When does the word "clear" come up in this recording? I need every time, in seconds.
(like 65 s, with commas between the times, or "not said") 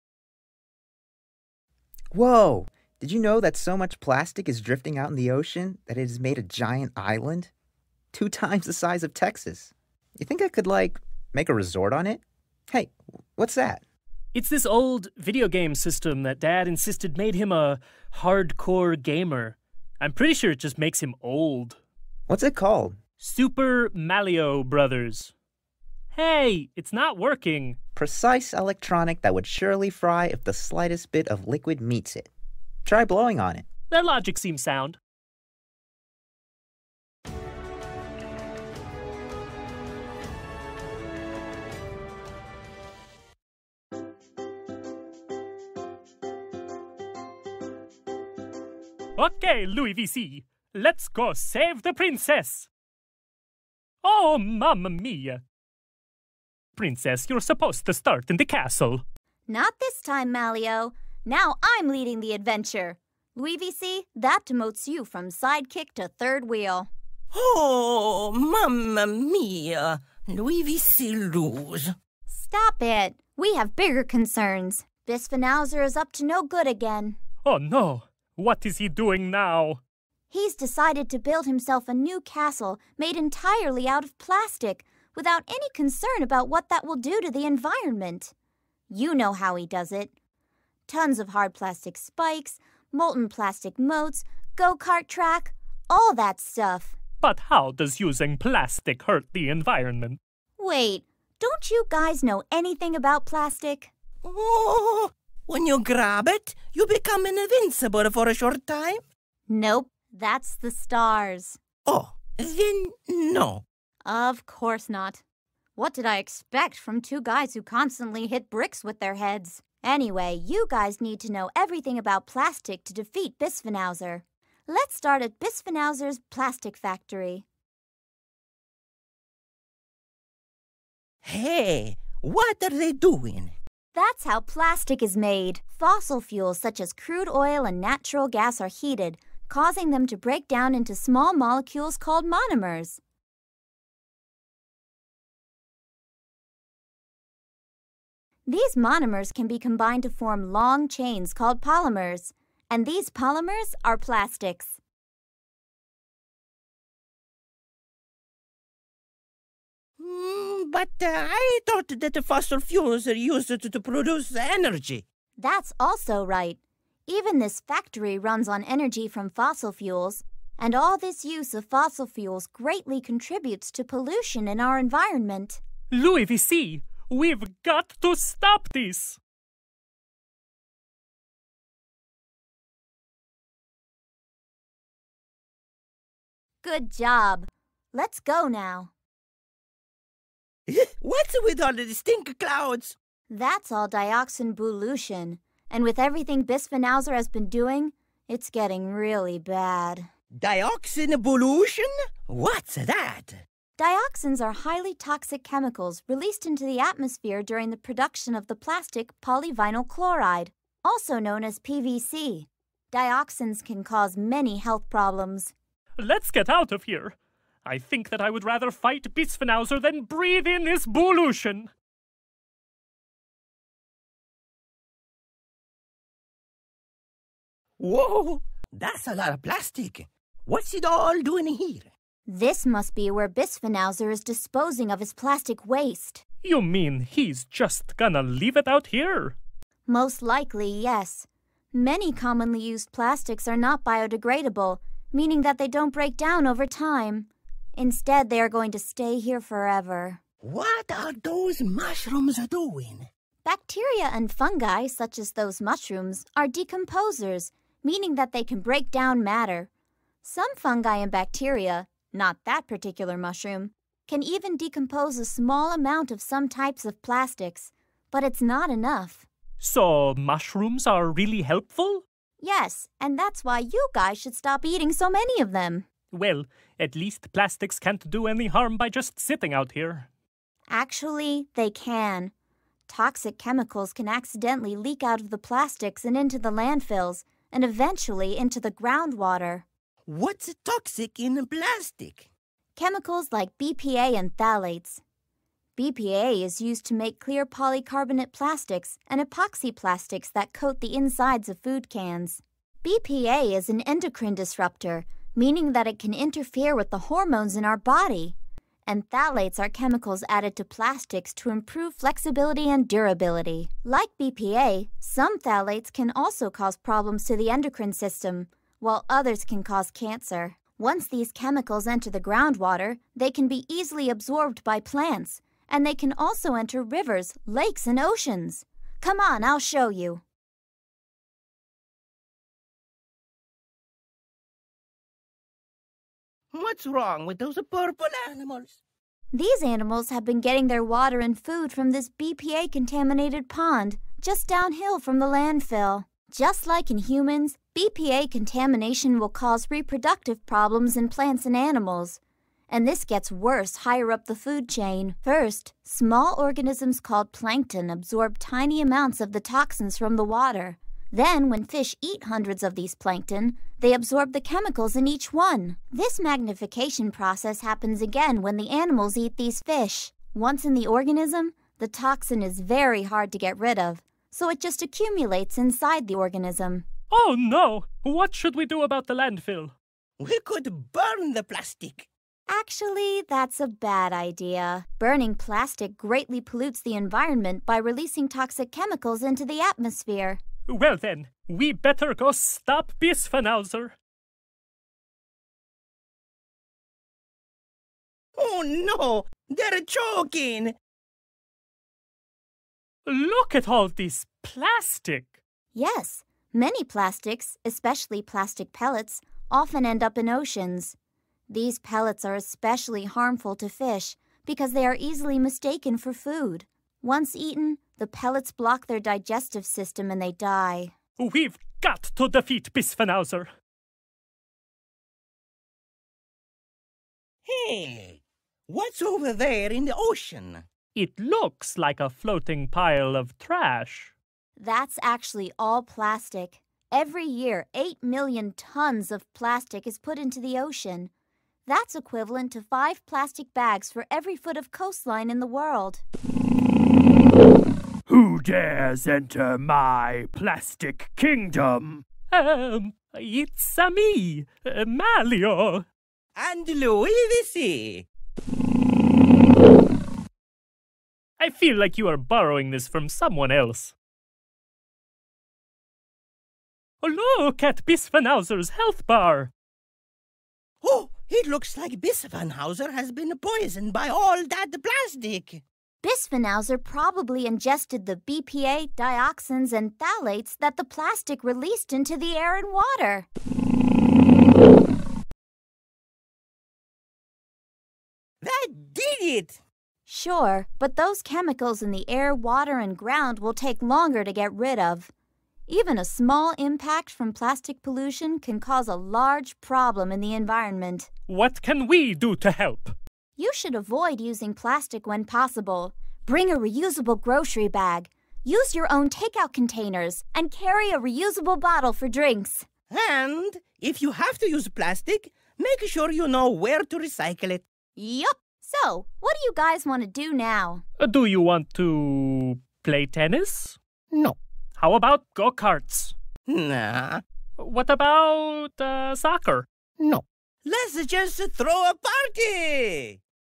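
297 s.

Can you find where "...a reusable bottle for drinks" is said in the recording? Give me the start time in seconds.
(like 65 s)
510 s.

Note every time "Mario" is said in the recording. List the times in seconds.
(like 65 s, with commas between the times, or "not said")
23 s, 454 s.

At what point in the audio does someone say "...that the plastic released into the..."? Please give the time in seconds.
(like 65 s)
480 s.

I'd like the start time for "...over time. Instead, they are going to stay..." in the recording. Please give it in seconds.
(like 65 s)
246 s.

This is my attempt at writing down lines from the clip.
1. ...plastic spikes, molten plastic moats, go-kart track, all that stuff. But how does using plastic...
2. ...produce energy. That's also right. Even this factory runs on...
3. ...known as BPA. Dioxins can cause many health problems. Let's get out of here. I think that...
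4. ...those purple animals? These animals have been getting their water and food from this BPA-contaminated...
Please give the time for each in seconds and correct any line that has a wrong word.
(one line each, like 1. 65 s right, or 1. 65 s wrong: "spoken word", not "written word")
1. 91 s right
2. 163 s right
3. 211 s wrong: "PVC", not "BPA"
4. 337 s right.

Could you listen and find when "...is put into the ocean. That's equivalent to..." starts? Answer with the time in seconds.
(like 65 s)
439 s.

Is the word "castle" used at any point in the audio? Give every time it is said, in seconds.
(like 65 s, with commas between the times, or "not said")
58 s, 82 s.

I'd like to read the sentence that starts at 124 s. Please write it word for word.
Let's start at Bisphenauser's plastic factory.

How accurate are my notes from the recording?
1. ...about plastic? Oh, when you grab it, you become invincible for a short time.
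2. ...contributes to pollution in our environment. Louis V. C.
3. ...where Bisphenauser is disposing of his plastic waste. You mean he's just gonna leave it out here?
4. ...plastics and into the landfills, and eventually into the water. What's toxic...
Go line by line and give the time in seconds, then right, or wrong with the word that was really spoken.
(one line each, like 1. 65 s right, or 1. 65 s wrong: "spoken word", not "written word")
1. 102 s right
2. 173 s right
3. 233 s right
4. 285 s wrong: "groundwater", not "water".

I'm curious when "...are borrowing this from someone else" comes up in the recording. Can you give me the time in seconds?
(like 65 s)
462 s.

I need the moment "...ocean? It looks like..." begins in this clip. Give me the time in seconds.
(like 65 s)
429 s.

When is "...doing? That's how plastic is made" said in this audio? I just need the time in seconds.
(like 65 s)
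132 s.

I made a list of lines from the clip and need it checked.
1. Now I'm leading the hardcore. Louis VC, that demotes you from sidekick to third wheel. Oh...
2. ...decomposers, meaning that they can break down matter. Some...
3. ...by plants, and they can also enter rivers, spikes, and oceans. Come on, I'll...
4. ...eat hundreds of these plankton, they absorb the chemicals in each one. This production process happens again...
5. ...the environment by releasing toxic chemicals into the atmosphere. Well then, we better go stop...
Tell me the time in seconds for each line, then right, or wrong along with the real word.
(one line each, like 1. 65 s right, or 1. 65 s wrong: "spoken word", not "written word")
1. 61 s wrong: "adventure", not "hardcore"
2. 256 s right
3. 324 s wrong: "lakes", not "spikes"
4. 362 s wrong: "magnification", not "production"
5. 386 s right.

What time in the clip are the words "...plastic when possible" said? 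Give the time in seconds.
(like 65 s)
504 s.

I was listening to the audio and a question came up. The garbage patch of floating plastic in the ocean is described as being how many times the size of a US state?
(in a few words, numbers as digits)
2 times the size of Texas.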